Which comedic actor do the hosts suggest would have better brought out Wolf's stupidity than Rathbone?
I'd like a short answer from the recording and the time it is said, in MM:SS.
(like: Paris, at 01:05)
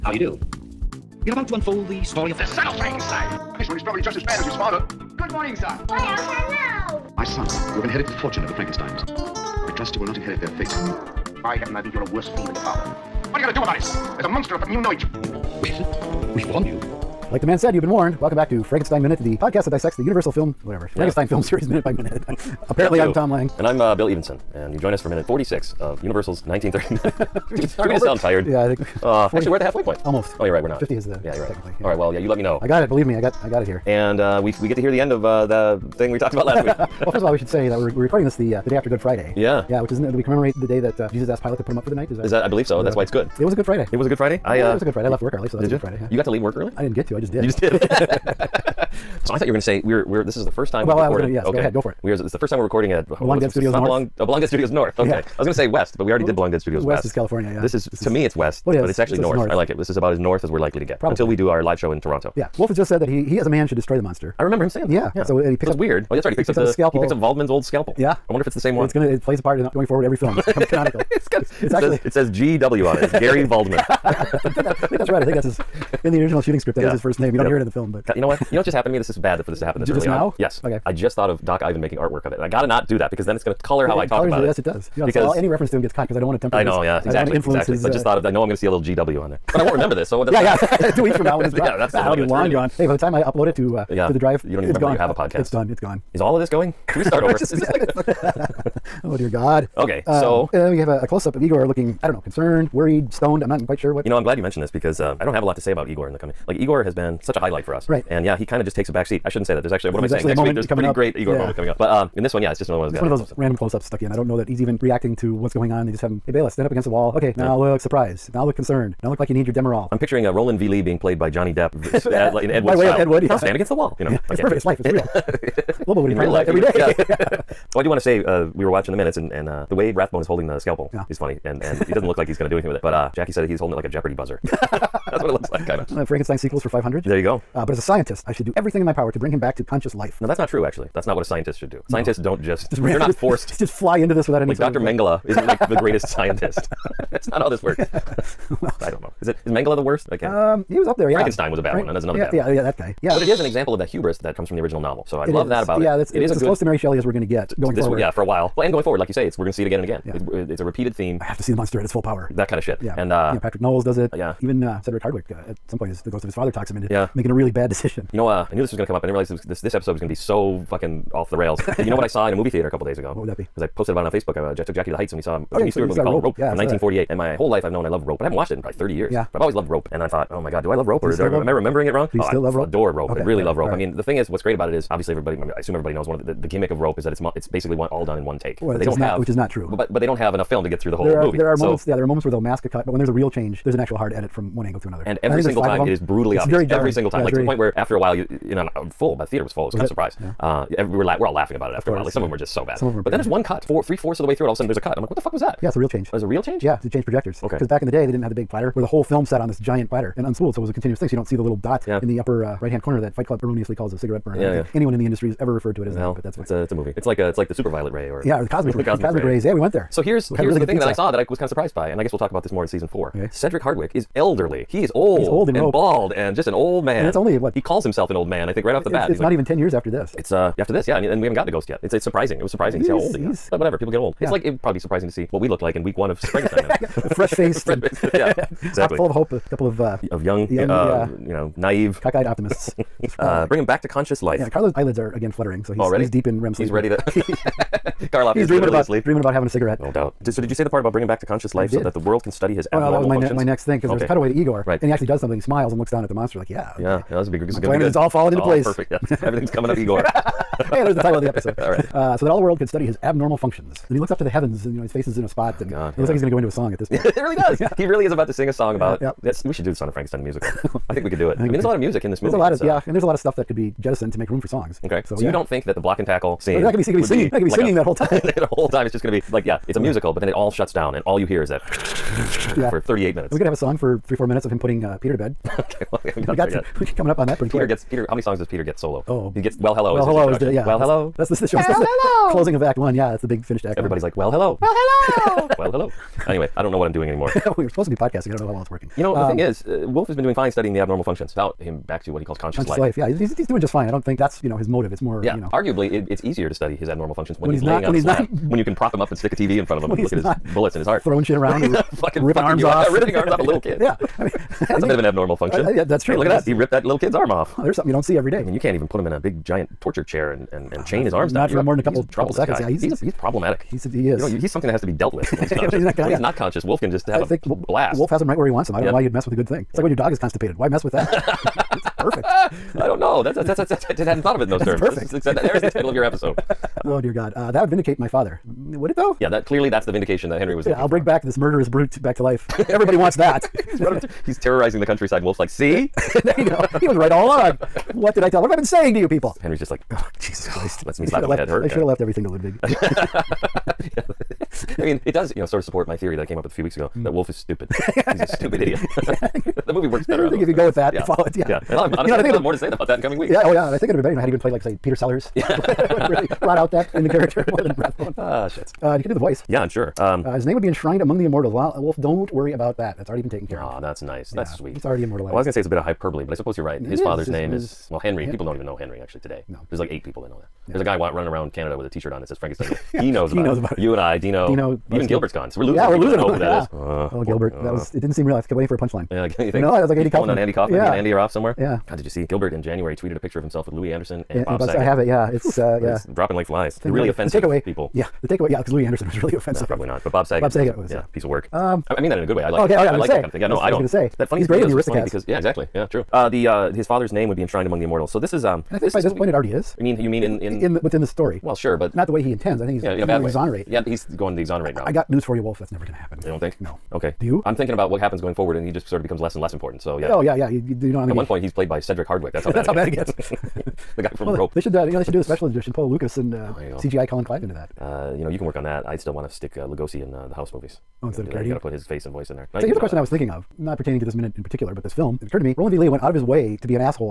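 Peter Sellers, at 06:04.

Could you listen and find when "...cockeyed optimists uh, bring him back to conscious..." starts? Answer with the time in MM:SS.
04:02.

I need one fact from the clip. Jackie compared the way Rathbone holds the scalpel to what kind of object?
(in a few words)
A Jeopardy buzzer.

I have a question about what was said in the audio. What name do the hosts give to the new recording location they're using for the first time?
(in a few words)
Belong Dead Studios North.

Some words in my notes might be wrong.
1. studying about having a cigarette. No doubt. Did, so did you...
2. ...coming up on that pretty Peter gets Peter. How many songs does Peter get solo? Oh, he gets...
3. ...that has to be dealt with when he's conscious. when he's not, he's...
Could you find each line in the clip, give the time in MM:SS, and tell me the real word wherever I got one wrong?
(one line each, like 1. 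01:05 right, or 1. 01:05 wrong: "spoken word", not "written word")
1. 04:09 wrong: "dreaming", not "studying"
2. 04:46 right
3. 05:24 right.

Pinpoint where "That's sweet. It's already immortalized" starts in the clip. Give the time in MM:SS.
06:14.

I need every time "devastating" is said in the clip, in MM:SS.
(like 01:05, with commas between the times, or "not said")
not said.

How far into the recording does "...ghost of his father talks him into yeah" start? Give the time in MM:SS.
02:46.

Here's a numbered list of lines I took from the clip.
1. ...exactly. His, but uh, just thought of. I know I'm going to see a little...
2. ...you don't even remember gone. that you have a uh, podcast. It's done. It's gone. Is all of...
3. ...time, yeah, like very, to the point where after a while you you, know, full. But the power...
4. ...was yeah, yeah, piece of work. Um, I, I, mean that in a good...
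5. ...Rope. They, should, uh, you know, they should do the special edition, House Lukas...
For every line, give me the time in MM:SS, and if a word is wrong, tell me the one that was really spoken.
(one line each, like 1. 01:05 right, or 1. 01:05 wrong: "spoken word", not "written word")
1. 01:27 right
2. 01:34 right
3. 03:17 wrong: "theater", not "power"
4. 06:40 right
5. 07:04 wrong: "Paul", not "House".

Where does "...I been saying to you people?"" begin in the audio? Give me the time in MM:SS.
05:48.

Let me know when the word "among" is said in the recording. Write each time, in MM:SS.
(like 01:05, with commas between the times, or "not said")
06:10, 06:47.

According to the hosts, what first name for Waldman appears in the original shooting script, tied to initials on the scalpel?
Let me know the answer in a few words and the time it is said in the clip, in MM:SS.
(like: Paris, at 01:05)
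Gary, at 01:13.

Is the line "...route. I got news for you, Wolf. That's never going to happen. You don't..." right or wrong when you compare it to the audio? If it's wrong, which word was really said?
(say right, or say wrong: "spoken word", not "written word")
right.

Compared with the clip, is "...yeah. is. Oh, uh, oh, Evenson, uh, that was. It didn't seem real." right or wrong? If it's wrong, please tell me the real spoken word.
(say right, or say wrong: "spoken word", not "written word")
wrong: "Gilbert", not "Evenson".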